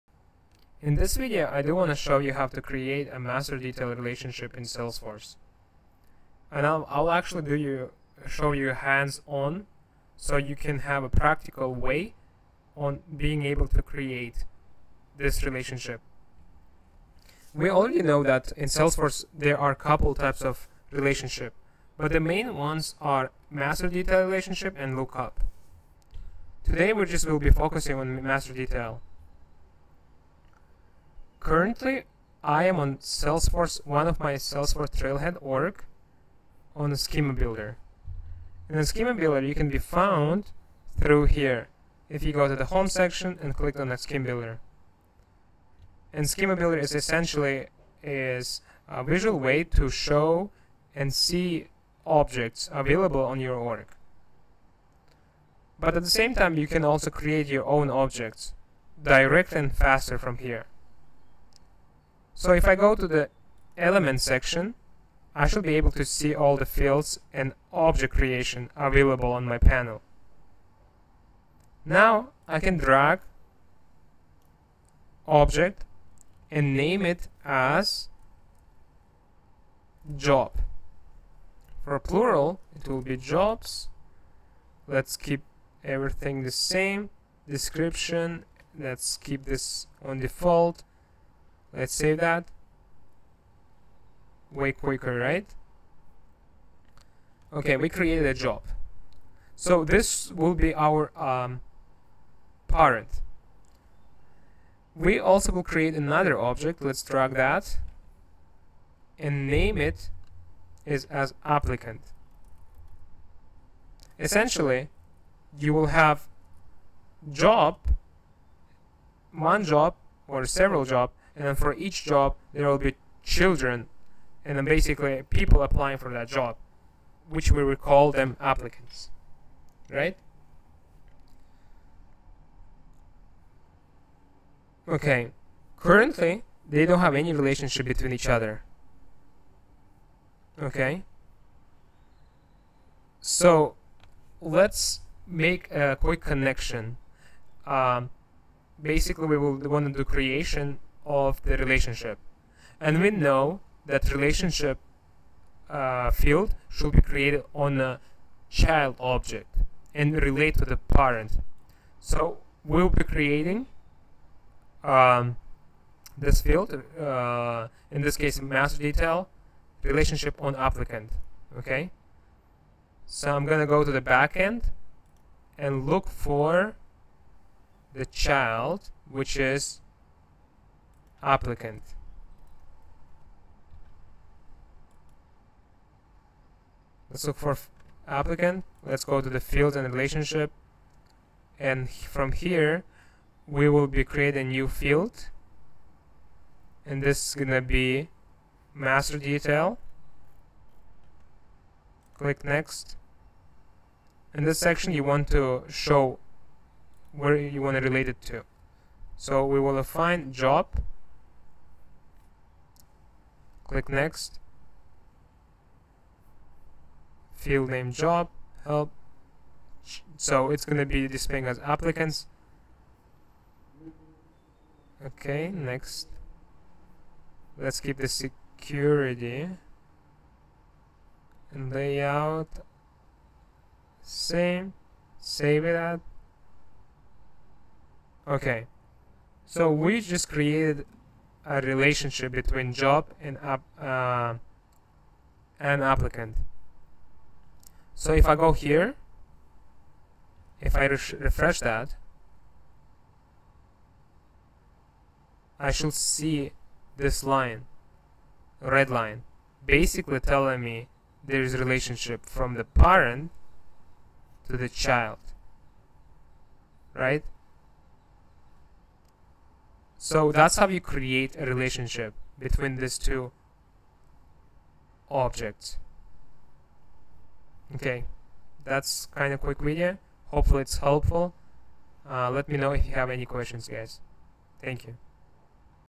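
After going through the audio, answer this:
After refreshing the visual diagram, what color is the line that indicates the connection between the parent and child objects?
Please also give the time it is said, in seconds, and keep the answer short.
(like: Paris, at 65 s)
red, at 258 s.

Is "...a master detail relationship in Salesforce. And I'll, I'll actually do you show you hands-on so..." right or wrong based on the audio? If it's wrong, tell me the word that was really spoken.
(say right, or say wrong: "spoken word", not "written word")
right.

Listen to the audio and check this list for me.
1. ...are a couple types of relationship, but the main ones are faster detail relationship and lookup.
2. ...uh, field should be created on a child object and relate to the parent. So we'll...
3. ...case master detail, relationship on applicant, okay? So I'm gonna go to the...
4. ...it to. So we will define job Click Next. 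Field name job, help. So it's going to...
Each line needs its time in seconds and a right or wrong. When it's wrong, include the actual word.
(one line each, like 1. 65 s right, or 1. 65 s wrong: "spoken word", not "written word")
1. 19 s wrong: "master", not "faster"
2. 155 s right
3. 168 s right
4. 208 s right.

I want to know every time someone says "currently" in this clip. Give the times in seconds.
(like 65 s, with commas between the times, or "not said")
31 s, 135 s.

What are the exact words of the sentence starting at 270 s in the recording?
So that's how you create a relationship between these two objects.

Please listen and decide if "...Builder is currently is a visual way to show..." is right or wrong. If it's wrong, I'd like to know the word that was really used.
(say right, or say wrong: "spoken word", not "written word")
wrong: "essentially", not "currently".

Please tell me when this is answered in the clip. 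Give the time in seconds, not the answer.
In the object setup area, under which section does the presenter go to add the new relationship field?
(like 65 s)
189 s.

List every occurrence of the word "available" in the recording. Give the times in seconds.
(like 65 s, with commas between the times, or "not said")
52 s, 68 s.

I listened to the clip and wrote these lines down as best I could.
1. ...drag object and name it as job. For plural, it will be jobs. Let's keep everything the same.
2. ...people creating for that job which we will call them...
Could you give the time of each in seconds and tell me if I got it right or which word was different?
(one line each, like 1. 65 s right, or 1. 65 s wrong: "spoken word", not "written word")
1. 72 s right
2. 125 s wrong: "applying", not "creating".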